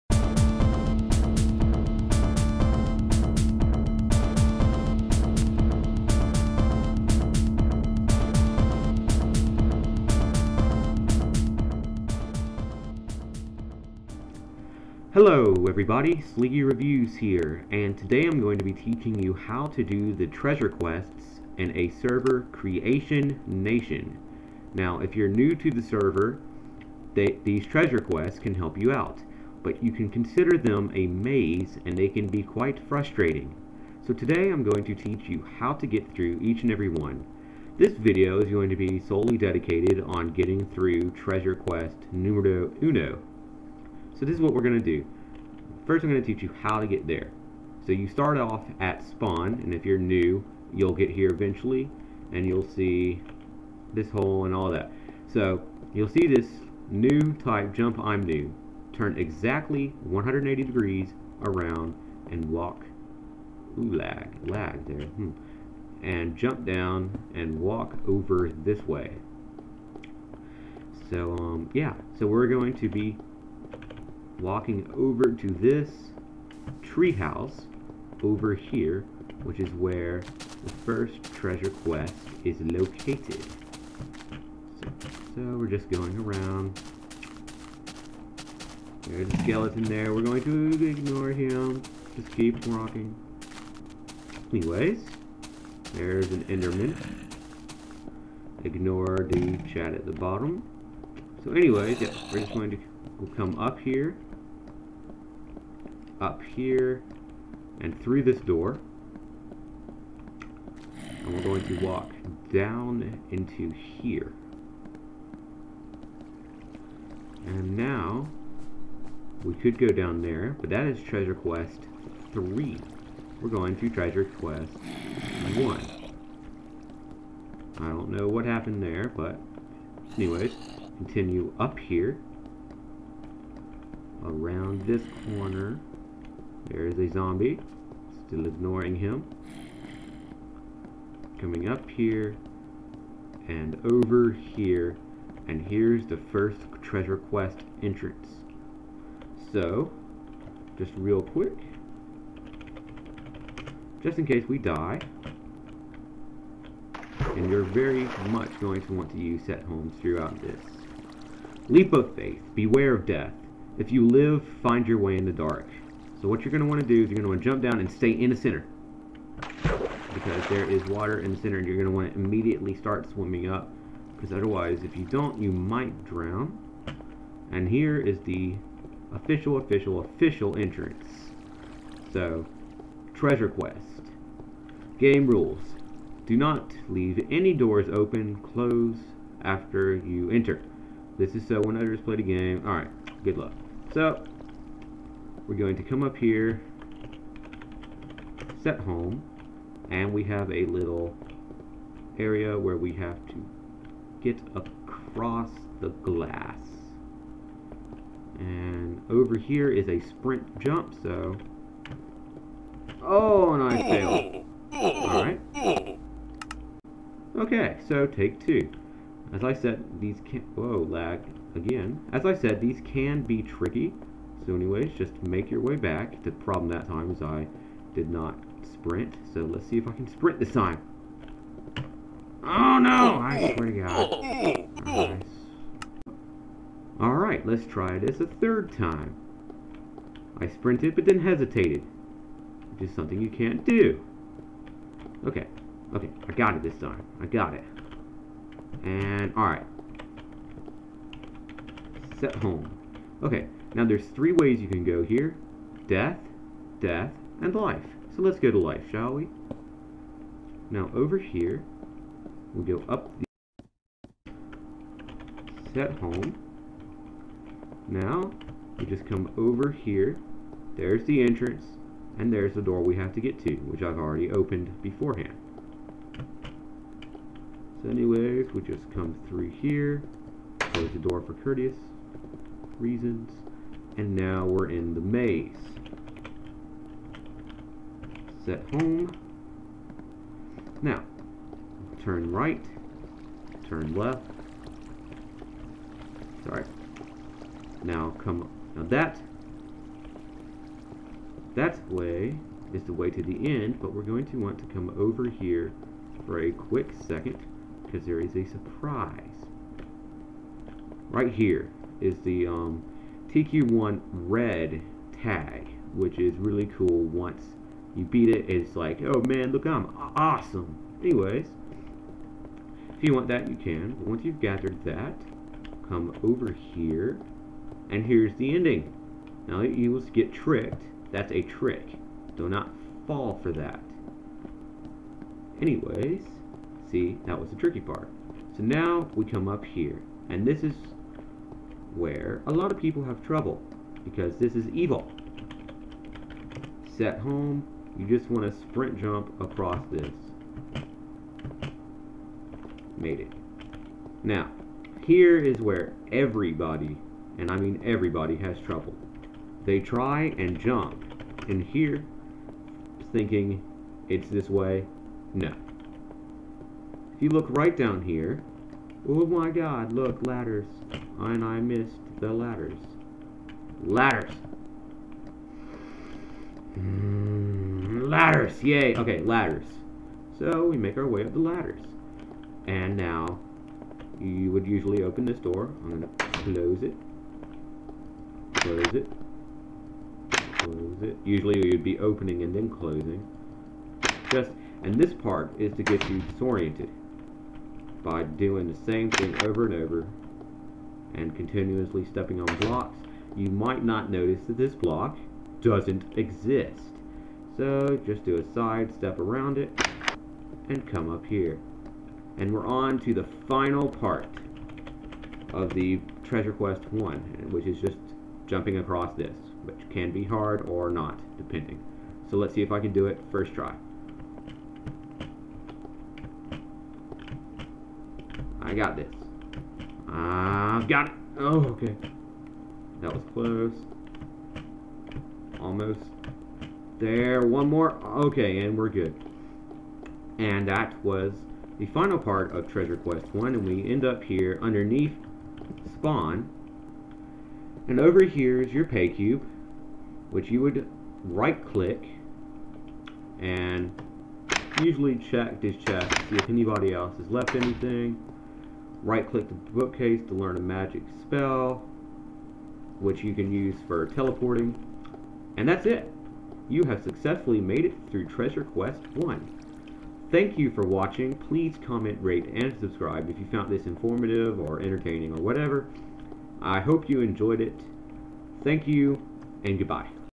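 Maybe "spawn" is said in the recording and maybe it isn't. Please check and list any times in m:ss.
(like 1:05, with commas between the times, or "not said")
0:49, 7:25.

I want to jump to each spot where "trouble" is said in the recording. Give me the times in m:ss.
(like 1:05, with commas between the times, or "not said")
5:43, 5:58.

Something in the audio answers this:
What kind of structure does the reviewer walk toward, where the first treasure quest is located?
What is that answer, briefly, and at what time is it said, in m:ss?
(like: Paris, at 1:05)
Treehouse, at 1:16.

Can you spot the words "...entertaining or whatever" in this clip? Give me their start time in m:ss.
7:54.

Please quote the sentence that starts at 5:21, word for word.
Anyways, if you want that, you can.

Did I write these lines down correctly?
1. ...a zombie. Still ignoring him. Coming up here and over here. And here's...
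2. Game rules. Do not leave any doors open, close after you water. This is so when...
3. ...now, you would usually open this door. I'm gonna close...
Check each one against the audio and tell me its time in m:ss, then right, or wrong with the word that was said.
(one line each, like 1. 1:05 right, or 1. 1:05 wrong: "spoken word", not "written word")
1. 2:16 right
2. 3:04 wrong: "enter", not "water"
3. 6:22 right.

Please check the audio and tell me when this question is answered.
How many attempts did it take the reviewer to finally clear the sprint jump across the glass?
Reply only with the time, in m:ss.
3:58.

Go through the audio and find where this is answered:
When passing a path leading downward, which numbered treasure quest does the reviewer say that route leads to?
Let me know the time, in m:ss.
2:01.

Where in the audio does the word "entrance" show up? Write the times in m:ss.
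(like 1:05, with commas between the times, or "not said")
2:27, 3:00, 4:31.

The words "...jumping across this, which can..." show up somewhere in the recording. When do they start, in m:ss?
6:58.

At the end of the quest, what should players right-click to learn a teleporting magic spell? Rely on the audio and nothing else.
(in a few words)
The bookcase.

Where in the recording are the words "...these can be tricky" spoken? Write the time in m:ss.
3:42.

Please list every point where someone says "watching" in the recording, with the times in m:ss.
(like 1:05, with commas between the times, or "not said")
7:50.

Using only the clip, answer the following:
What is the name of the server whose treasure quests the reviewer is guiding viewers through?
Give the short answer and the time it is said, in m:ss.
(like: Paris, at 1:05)
Creation Nation, at 0:22.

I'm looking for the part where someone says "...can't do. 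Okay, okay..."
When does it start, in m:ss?
4:03.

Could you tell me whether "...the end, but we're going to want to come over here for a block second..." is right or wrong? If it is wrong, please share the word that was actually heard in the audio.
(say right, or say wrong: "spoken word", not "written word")
wrong: "quick", not "block".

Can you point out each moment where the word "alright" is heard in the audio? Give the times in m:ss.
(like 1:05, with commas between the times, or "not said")
3:12, 3:34, 3:56, 4:09.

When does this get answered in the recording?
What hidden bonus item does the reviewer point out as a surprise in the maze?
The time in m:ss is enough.
5:13.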